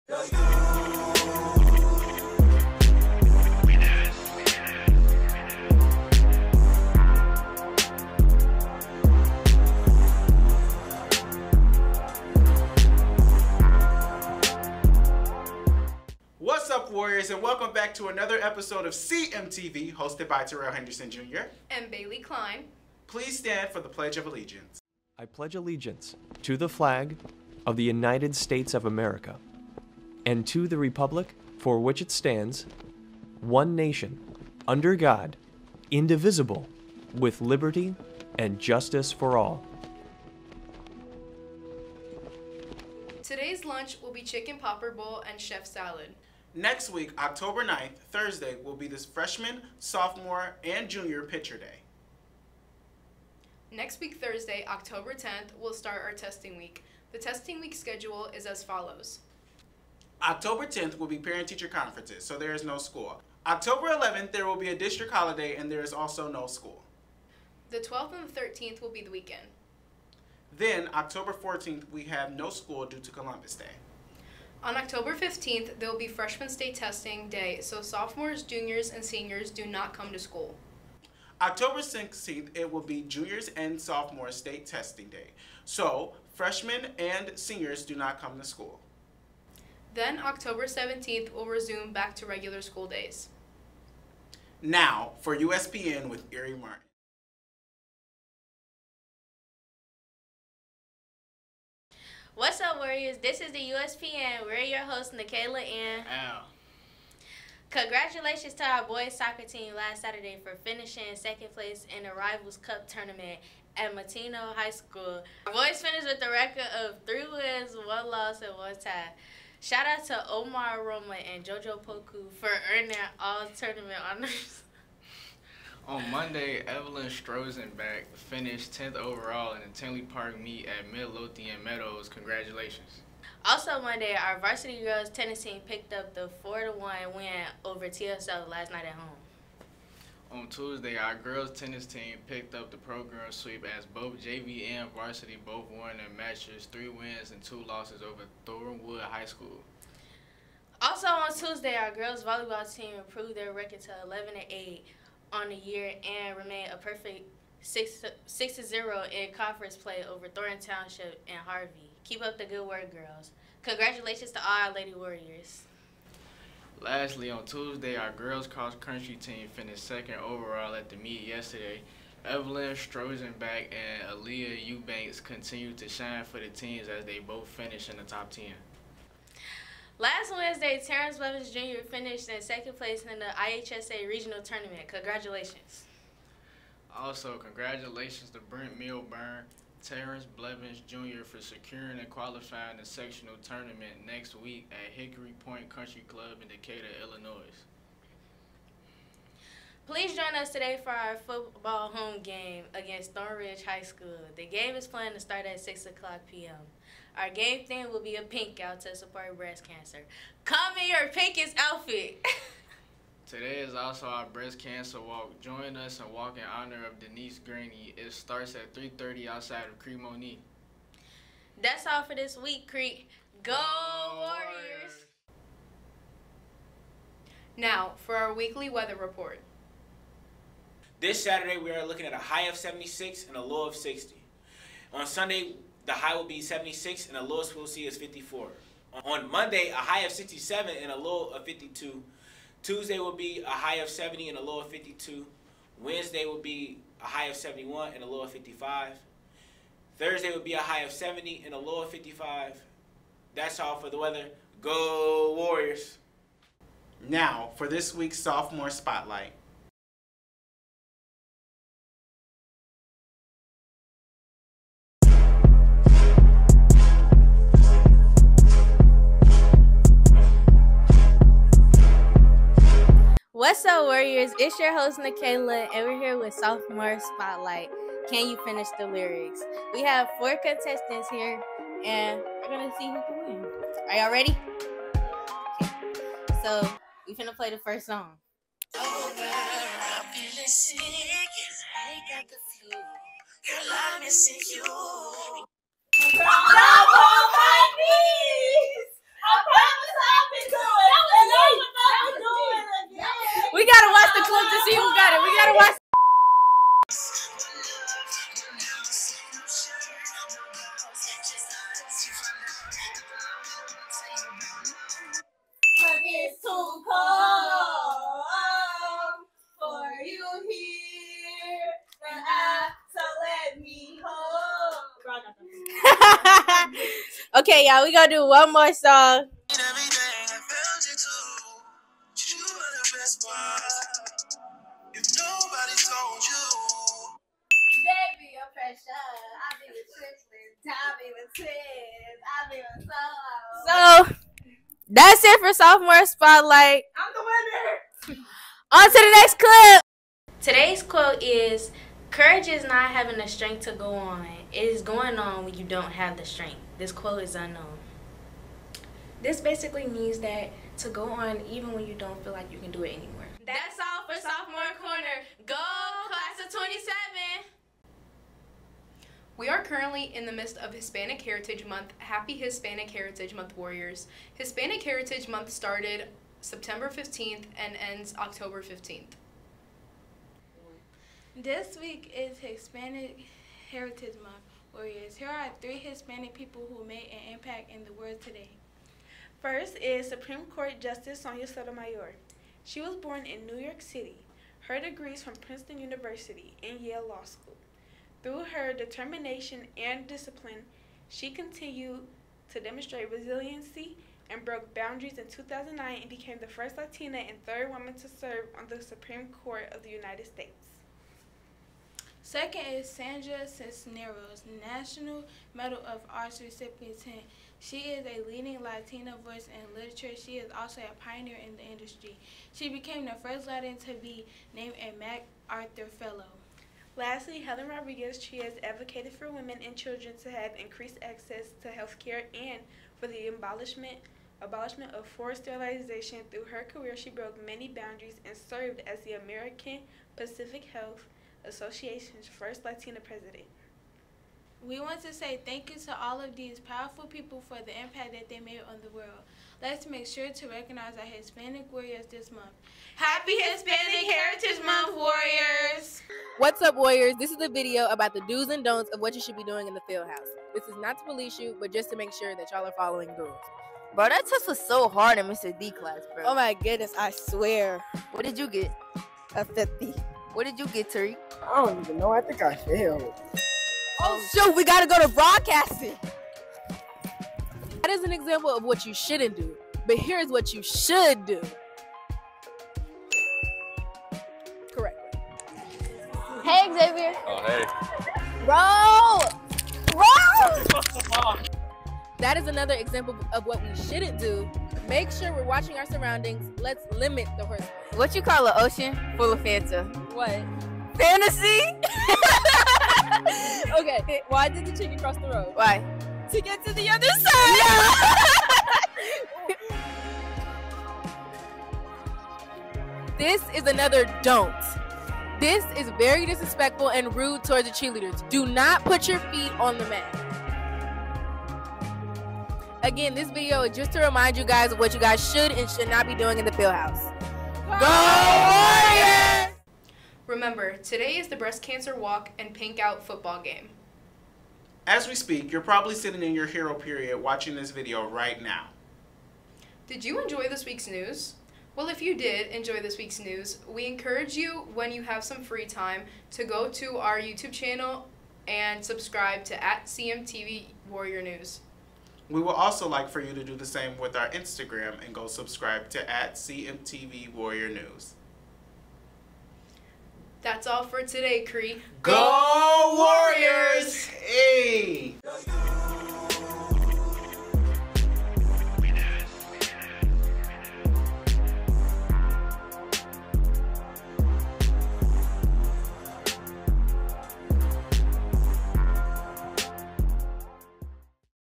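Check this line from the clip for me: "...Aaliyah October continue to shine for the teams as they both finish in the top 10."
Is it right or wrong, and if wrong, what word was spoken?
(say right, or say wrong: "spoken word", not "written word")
wrong: "Eubanks", not "October".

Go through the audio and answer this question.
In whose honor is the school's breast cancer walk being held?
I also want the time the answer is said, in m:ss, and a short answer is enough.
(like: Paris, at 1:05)
Denise Graney, at 3:36.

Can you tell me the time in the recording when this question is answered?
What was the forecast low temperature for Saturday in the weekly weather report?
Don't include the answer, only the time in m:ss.
3:53.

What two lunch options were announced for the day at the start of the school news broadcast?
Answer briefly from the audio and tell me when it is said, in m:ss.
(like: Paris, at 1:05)
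Chicken popper bowl and chef salad, at 0:44.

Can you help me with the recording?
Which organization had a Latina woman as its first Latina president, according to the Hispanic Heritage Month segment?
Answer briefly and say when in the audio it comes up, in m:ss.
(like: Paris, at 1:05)
American Public Health Association, at 7:19.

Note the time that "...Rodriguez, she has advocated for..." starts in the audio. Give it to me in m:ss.
7:07.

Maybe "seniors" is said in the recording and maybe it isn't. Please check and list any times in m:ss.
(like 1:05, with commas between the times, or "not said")
1:19, 1:27.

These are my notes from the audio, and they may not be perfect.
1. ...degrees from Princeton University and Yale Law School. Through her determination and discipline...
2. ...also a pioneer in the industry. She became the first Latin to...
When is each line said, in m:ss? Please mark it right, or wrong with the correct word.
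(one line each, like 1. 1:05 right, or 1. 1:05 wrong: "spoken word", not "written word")
1. 6:34 right
2. 7:00 right.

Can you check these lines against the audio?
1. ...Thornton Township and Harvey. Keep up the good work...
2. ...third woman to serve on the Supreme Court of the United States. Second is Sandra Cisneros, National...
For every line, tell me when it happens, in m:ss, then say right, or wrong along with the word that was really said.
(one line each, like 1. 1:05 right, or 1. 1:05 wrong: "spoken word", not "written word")
1. 2:40 right
2. 6:47 right.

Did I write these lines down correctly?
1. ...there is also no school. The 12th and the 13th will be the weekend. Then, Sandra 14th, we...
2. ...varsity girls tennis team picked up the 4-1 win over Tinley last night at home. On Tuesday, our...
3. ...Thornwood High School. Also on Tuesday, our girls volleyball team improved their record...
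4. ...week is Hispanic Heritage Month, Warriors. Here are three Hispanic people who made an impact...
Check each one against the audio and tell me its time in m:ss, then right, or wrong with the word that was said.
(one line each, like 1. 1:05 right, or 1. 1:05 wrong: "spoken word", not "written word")
1. 1:05 wrong: "October", not "Sandra"
2. 2:14 wrong: "TSL", not "Tinley"
3. 2:28 right
4. 6:21 right.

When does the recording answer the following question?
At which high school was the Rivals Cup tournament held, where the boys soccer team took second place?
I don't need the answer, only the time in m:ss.
1:53.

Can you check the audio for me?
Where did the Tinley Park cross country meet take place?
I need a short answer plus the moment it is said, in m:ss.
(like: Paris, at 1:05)
Midlothian Meadows, at 2:10.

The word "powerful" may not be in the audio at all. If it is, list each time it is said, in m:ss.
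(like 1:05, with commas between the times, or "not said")
7:26.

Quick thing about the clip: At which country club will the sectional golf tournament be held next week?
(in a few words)
Hickory Point Country Club.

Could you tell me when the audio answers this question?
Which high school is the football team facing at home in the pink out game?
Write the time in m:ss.
3:23.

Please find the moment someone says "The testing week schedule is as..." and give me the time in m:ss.
0:57.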